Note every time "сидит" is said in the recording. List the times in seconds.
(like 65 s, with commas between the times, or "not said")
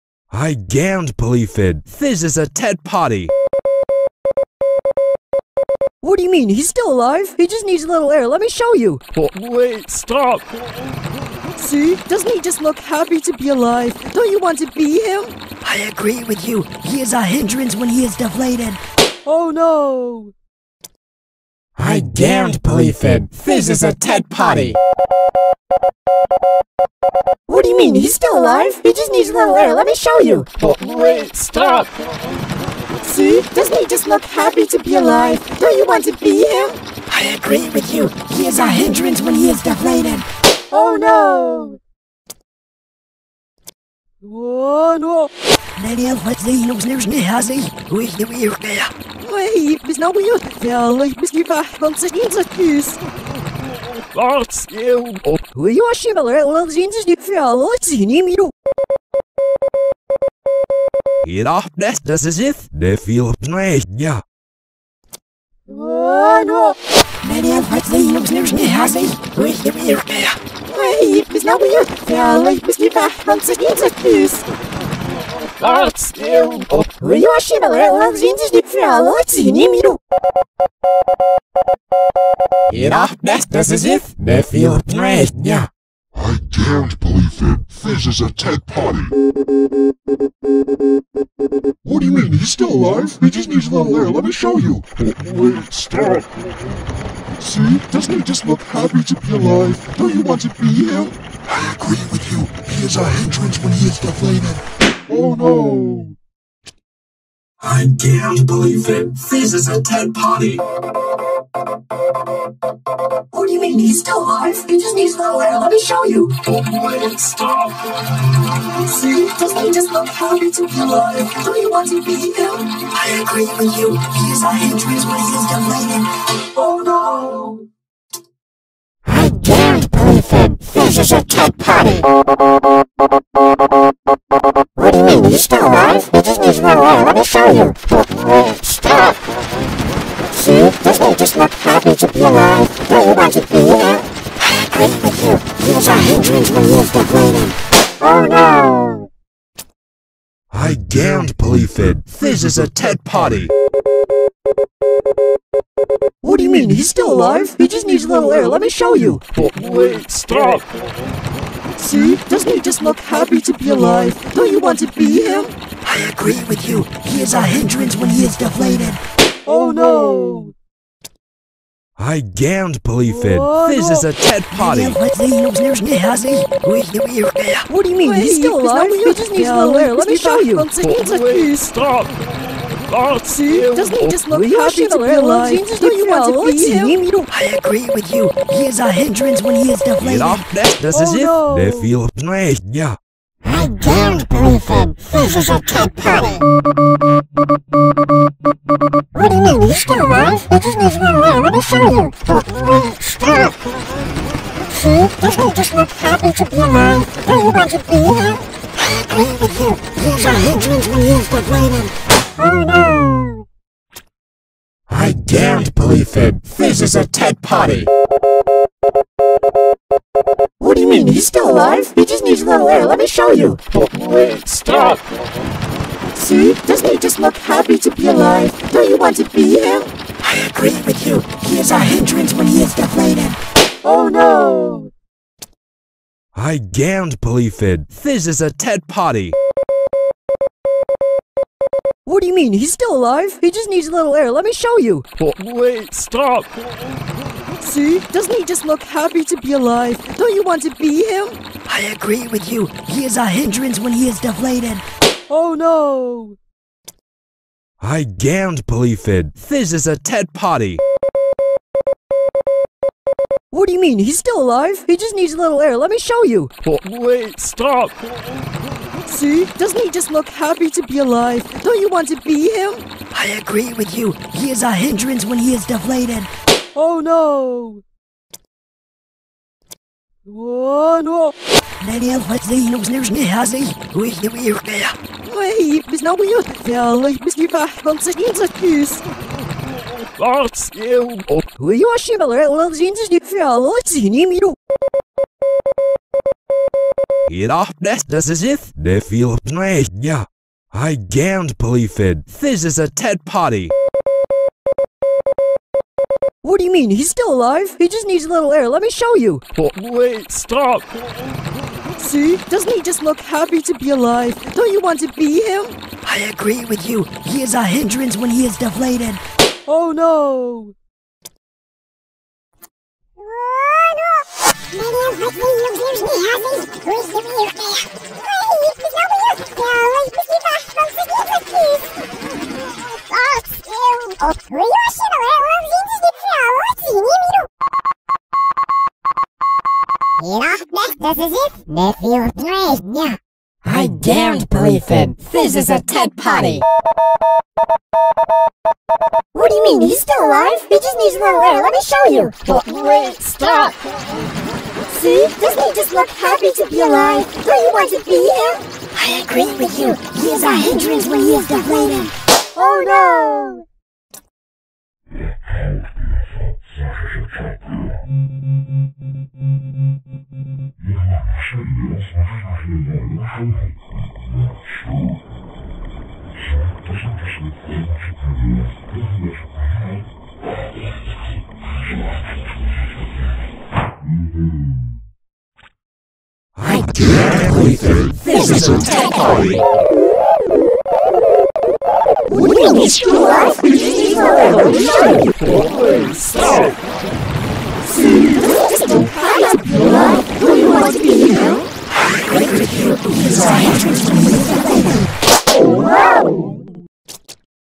51 s, 287 s.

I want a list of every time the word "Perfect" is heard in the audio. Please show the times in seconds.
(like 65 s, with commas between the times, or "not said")
129 s.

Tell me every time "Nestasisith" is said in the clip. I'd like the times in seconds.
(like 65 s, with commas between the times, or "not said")
83 s.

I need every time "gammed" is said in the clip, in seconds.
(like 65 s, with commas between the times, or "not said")
236 s, 258 s.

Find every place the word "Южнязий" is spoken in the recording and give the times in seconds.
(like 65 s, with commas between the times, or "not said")
282 s.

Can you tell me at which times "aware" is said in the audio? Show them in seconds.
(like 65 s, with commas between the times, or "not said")
179 s.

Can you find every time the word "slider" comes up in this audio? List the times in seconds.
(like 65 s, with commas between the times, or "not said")
not said.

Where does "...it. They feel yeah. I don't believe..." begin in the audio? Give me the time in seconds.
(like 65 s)
191 s.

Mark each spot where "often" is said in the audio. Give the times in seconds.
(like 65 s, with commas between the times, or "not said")
297 s.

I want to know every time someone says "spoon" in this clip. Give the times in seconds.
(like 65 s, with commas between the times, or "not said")
not said.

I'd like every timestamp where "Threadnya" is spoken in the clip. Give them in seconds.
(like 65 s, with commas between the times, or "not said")
84 s.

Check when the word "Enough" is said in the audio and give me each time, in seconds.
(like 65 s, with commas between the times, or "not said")
82 s.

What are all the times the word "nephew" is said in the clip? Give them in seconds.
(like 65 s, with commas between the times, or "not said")
84 s, 341 s.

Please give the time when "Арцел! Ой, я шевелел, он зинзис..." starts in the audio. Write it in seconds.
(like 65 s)
290 s.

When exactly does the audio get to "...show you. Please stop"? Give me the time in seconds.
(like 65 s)
180 s.